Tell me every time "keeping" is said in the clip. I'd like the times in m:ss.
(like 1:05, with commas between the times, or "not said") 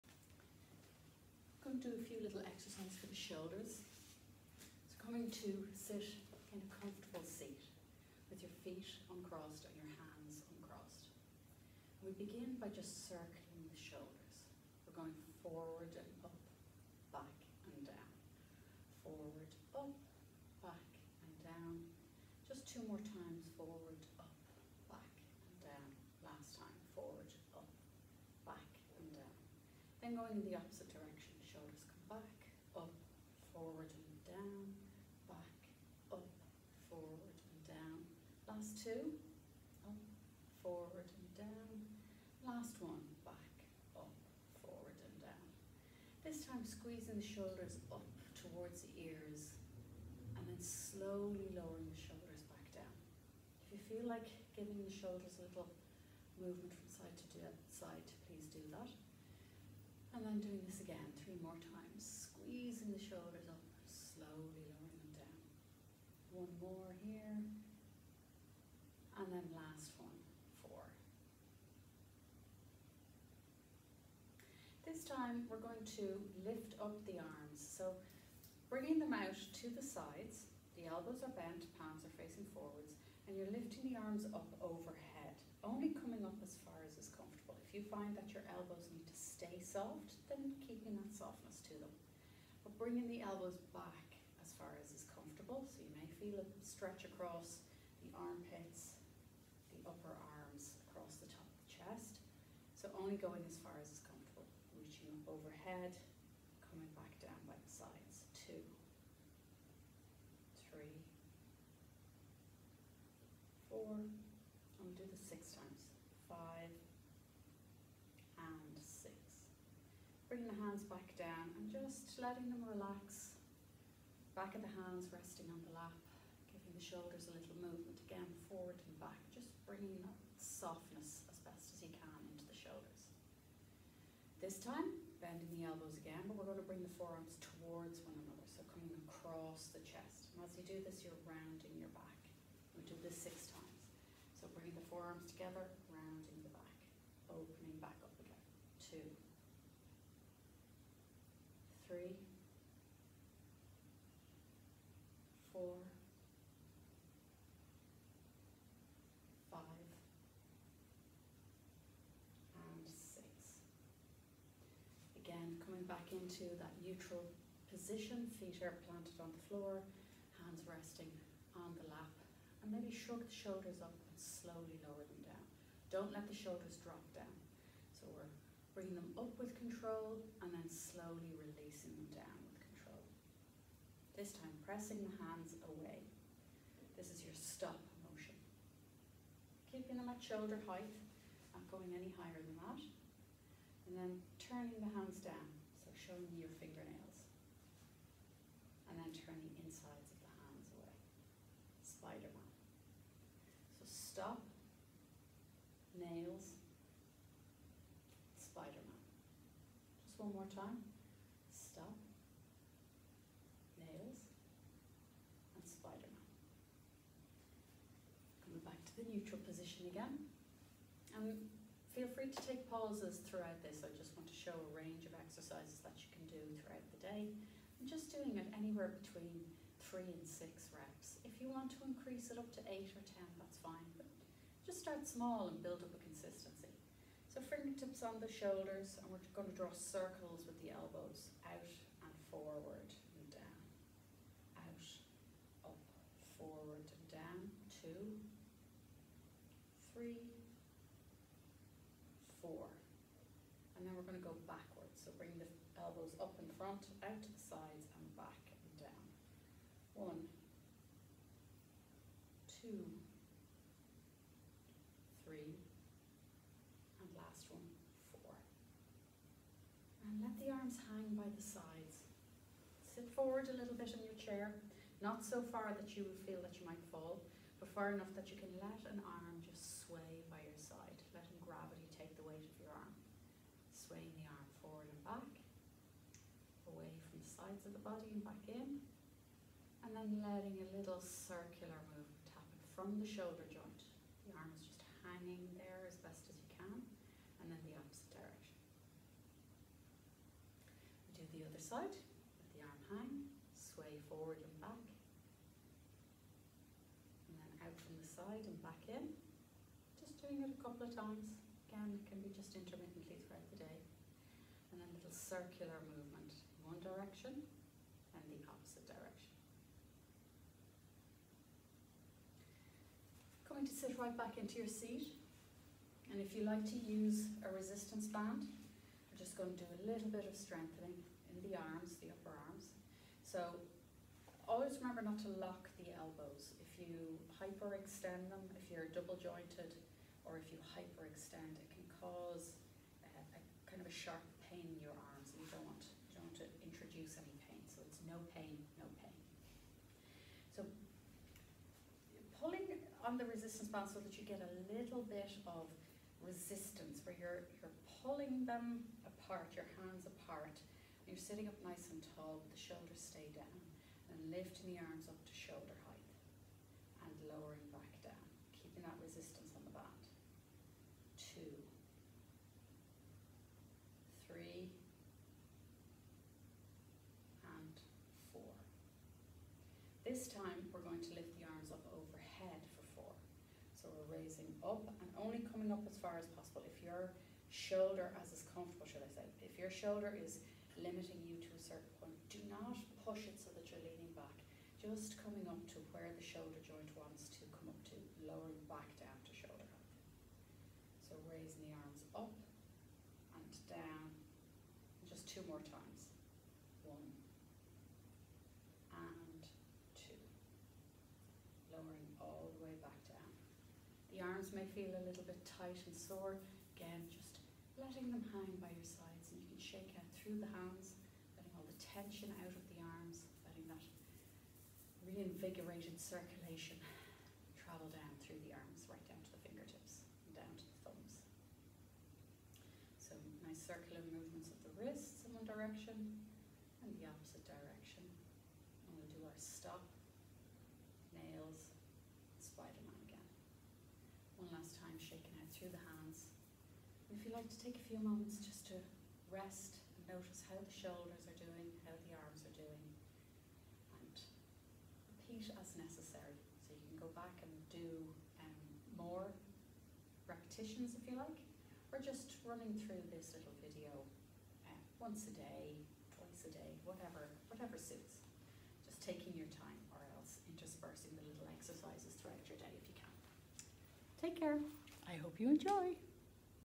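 1:30, 3:09, 6:08.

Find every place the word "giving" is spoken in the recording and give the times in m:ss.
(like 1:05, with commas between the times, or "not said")
0:54, 2:06.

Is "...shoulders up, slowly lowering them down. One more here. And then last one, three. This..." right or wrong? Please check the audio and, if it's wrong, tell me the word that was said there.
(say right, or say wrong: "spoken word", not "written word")
wrong: "four", not "three".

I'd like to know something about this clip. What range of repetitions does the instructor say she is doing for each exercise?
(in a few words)
3 to 6.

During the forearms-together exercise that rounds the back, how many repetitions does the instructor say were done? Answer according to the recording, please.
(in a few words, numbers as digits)
6.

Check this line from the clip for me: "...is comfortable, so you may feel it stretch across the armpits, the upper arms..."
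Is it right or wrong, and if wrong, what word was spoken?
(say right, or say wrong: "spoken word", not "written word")
right.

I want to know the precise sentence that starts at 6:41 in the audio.
So raising the arms up and down, just two more times.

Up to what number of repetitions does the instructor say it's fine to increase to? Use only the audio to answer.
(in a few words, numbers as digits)
8 or 10.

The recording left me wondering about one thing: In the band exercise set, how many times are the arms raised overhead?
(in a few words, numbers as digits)
4.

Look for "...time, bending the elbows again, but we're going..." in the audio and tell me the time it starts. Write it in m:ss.
2:14.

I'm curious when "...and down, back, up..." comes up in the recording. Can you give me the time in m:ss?
0:33.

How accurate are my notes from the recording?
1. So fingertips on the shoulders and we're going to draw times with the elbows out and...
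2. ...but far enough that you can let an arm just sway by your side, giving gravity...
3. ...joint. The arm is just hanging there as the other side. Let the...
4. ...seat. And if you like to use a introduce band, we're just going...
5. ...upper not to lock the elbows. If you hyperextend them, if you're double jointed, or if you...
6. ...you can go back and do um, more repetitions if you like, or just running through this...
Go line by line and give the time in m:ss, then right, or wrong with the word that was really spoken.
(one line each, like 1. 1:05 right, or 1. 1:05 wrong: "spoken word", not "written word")
1. 3:57 wrong: "circles", not "times"
2. 4:37 wrong: "letting", not "giving"
3. 4:53 right
4. 5:24 wrong: "resistance", not "introduce"
5. 5:34 wrong: "remember", not "upper"
6. 7:36 right.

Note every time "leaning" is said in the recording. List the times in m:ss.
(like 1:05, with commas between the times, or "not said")
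6:33.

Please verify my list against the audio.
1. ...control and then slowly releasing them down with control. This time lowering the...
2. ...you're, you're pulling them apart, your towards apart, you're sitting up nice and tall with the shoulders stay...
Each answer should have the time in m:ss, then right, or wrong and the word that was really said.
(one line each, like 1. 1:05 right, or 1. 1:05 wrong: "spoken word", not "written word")
1. 2:59 wrong: "pressing", not "lowering"
2. 5:57 wrong: "hands", not "towards".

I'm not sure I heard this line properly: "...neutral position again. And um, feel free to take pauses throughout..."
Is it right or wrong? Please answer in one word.
right.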